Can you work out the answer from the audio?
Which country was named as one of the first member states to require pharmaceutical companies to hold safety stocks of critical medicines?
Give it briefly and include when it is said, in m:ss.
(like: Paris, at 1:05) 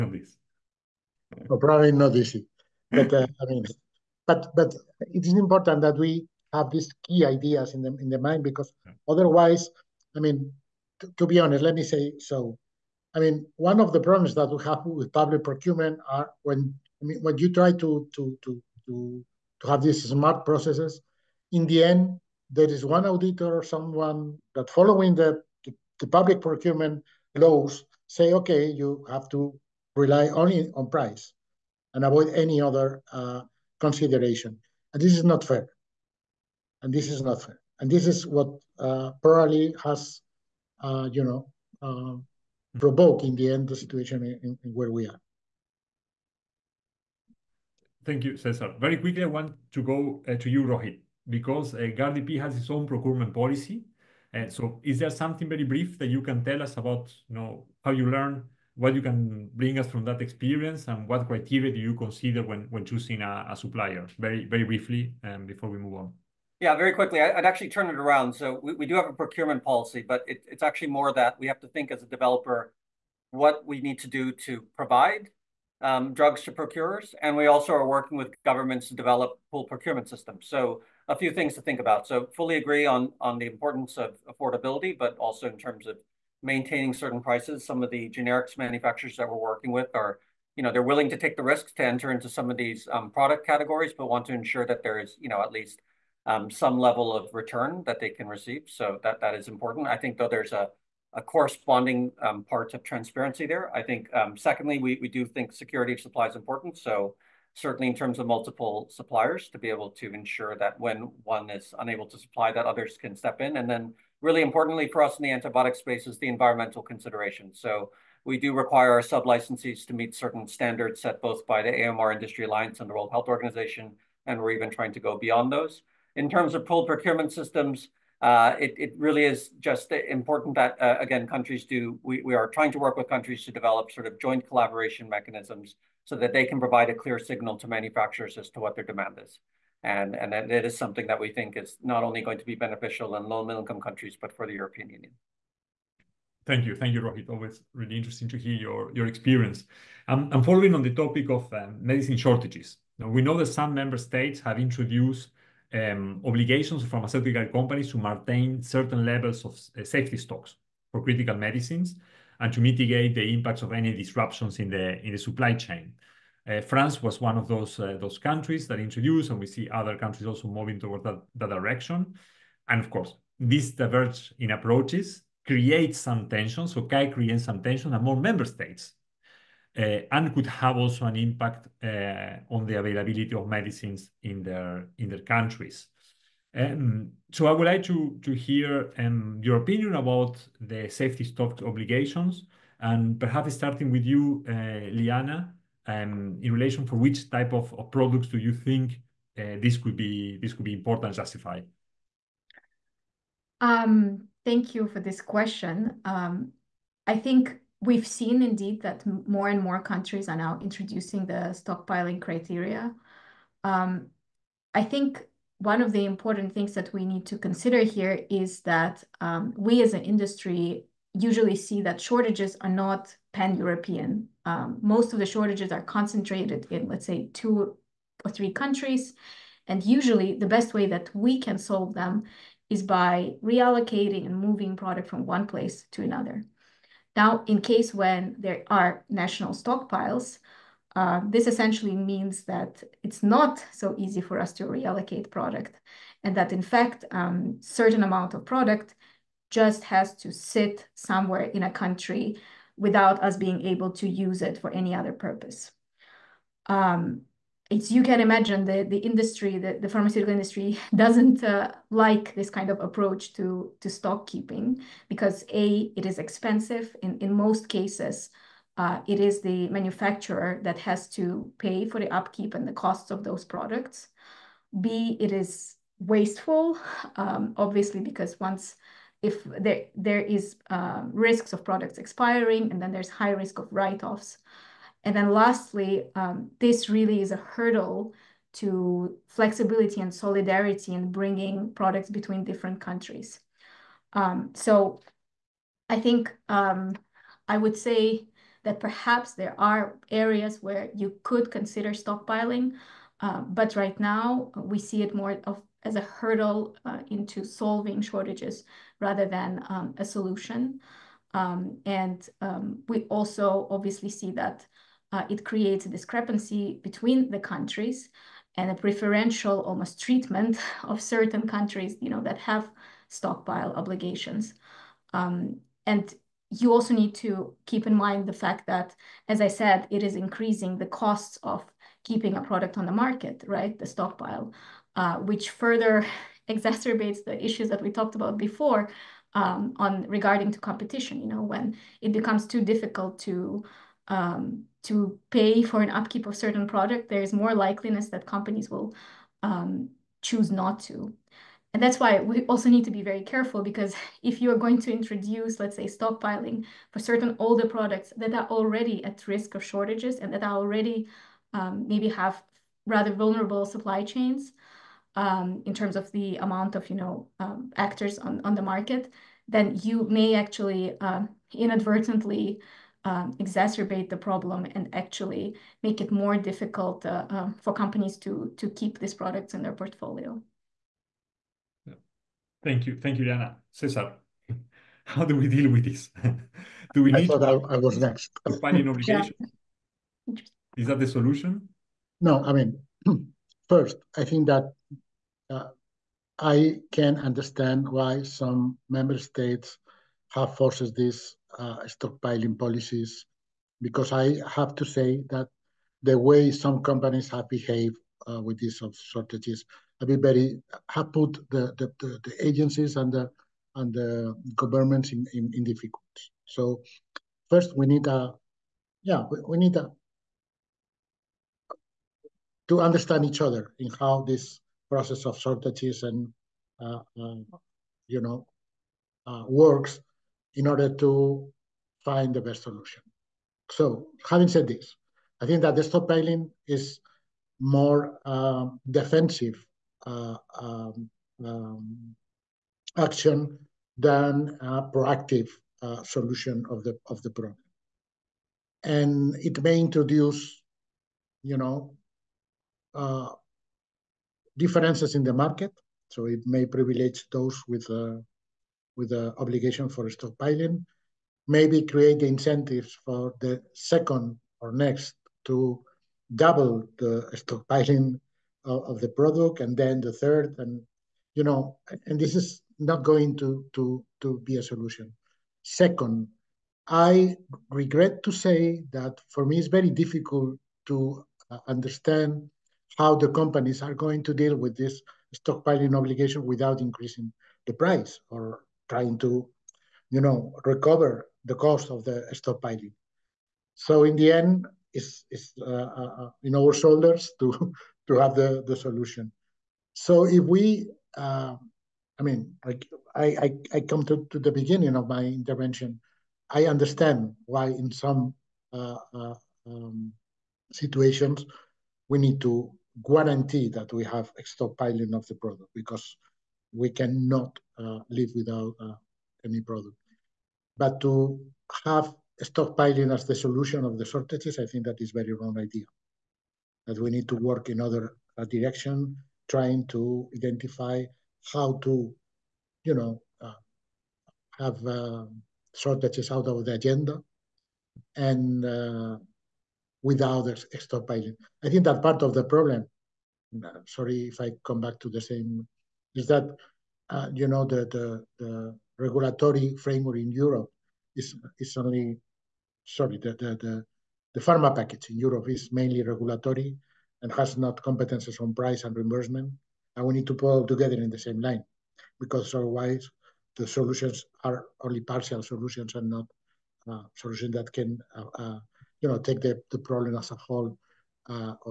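France, at 2:46.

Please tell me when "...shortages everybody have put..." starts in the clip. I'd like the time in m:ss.
6:48.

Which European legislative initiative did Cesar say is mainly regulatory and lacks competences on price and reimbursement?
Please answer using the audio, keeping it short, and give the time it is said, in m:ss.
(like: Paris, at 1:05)
The pharma package, at 9:14.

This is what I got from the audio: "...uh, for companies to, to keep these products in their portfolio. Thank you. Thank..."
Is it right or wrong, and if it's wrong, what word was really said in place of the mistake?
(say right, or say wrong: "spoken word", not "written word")
right.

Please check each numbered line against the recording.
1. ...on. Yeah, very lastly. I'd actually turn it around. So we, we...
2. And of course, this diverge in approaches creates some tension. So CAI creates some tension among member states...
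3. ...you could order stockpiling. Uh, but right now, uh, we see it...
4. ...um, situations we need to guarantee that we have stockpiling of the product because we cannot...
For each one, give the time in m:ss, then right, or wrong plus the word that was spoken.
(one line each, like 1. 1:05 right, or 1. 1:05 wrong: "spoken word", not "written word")
1. 1:05 wrong: "quickly", not "lastly"
2. 2:52 right
3. 5:00 wrong: "consider", not "order"
4. 8:29 right.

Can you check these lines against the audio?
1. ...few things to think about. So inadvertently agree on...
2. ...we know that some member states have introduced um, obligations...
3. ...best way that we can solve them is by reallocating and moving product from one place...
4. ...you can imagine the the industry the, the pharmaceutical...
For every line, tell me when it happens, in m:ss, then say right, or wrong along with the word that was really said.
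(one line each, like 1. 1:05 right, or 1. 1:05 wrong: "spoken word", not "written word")
1. 1:21 wrong: "fully", not "inadvertently"
2. 2:33 right
3. 3:50 right
4. 4:17 right.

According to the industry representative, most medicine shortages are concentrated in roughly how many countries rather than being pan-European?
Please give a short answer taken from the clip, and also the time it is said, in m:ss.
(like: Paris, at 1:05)
2 or 3, at 3:47.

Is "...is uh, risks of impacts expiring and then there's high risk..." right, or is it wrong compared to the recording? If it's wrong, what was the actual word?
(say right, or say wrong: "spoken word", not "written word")
wrong: "products", not "impacts".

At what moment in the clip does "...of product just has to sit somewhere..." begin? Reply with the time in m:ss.
4:08.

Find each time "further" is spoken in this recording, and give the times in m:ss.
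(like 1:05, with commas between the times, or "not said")
5:35.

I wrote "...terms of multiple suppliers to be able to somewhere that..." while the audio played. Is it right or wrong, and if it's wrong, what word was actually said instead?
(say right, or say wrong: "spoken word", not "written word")
wrong: "ensure", not "somewhere".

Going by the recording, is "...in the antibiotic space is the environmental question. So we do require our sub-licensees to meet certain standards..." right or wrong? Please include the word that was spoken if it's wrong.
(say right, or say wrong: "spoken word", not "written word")
wrong: "consideration", not "question".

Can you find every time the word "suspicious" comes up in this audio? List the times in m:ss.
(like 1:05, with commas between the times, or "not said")
not said.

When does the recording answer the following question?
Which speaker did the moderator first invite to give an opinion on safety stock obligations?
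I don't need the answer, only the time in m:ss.
3:14.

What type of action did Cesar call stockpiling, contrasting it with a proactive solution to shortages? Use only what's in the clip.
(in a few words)
Defensive.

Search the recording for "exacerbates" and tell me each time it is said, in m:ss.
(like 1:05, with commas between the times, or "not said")
5:36, 6:13.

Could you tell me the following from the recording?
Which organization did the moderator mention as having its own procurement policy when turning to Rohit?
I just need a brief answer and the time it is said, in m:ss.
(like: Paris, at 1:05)
GARDP, at 0:51.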